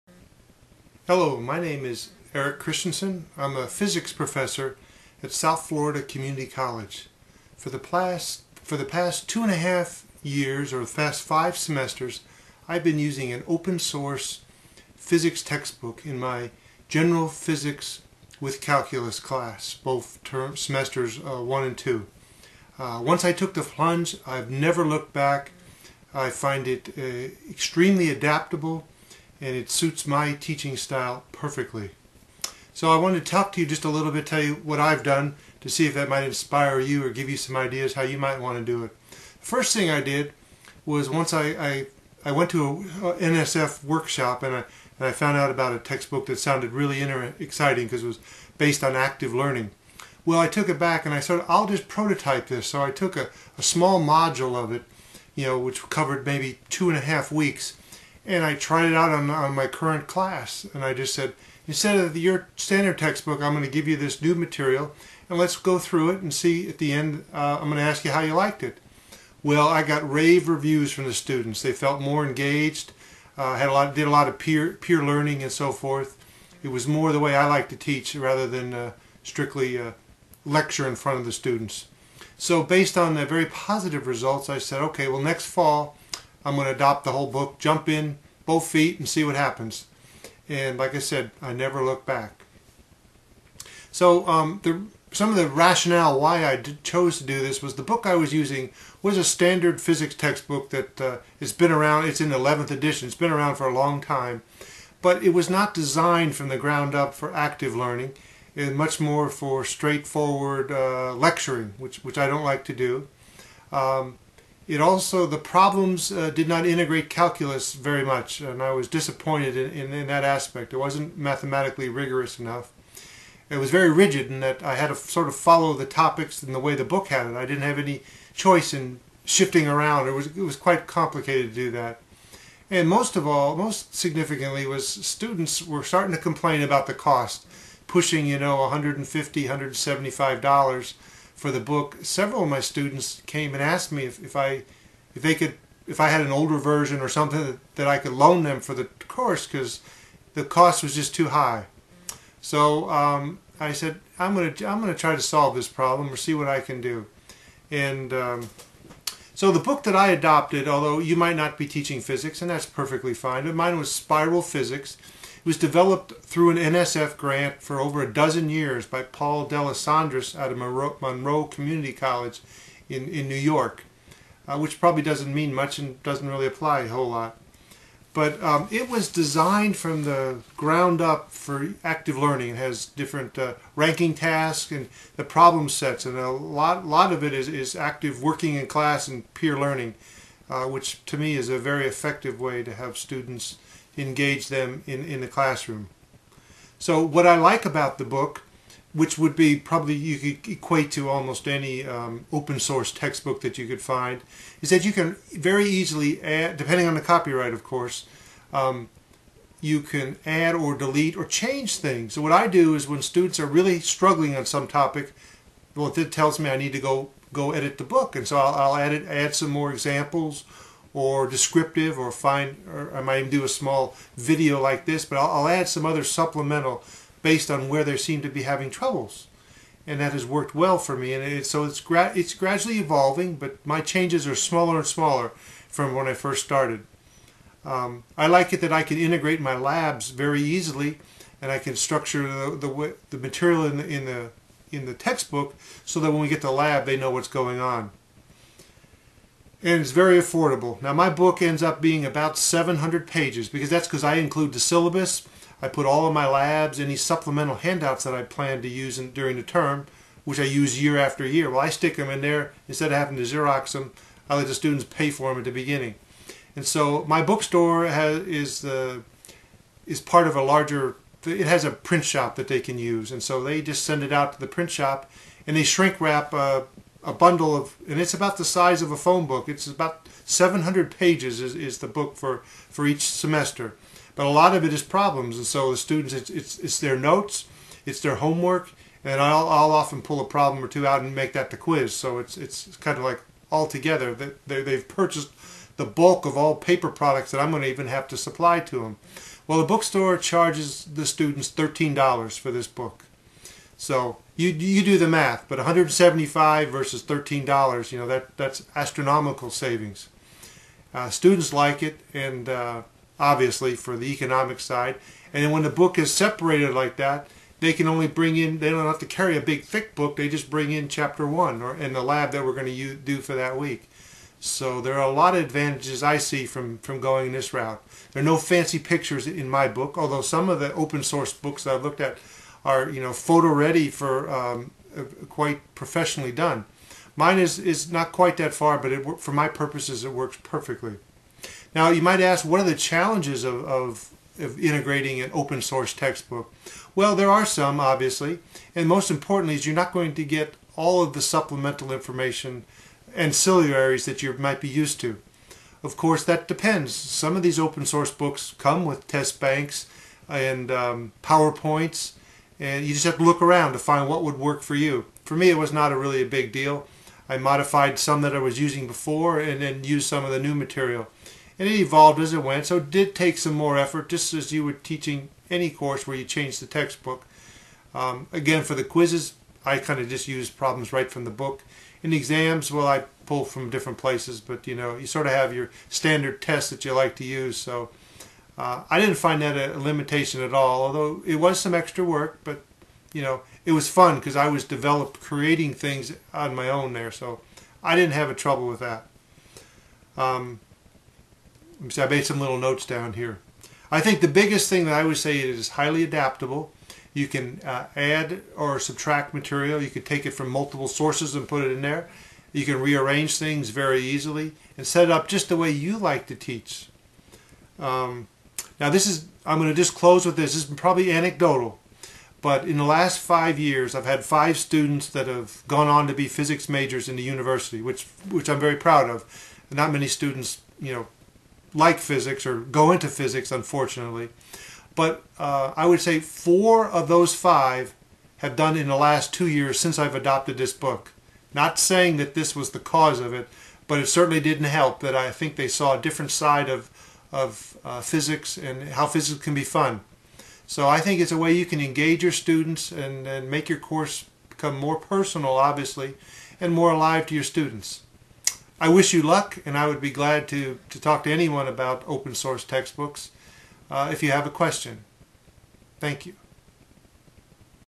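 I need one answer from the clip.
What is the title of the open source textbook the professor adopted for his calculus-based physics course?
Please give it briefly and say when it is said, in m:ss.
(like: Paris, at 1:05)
Spiral Physics, at 2:43.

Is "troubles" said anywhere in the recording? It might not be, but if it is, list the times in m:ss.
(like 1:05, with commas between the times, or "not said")
3:48, 6:38.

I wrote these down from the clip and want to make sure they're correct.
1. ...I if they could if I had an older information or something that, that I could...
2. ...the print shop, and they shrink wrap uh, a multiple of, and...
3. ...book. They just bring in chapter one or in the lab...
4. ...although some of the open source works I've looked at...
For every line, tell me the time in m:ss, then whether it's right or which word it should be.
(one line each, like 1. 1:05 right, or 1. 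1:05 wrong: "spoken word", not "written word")
1. 2:24 wrong: "version", not "information"
2. 4:34 wrong: "bundle", not "multiple"
3. 5:19 right
4. 5:29 wrong: "books", not "works".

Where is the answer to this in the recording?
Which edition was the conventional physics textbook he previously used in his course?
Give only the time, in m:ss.
1:42.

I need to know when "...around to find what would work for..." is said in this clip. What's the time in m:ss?
6:03.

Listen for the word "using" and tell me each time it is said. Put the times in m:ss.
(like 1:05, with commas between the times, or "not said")
0:12, 1:38, 6:08.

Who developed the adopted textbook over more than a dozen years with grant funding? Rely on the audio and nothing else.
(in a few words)
Paul D'Alessandris.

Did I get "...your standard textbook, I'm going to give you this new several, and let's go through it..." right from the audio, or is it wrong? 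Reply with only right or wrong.
wrong.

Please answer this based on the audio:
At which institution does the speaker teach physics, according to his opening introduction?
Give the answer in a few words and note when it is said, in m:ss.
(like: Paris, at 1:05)
South Florida Community College, at 0:05.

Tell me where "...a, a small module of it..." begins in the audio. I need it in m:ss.
0:53.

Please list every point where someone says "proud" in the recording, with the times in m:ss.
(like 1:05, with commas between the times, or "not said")
7:08.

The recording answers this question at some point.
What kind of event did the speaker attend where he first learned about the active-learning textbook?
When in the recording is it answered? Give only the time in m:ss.
0:43.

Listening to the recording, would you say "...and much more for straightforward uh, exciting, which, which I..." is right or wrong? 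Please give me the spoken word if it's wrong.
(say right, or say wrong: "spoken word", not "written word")
wrong: "lecturing", not "exciting".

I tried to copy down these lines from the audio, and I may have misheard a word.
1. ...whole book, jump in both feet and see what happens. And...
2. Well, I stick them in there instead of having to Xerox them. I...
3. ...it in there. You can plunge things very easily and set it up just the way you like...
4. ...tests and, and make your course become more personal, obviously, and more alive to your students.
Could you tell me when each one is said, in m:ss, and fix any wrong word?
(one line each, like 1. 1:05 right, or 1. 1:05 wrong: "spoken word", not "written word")
1. 1:27 right
2. 4:21 right
3. 6:51 wrong: "rearrange", not "plunge"
4. 7:32 wrong: "students", not "tests".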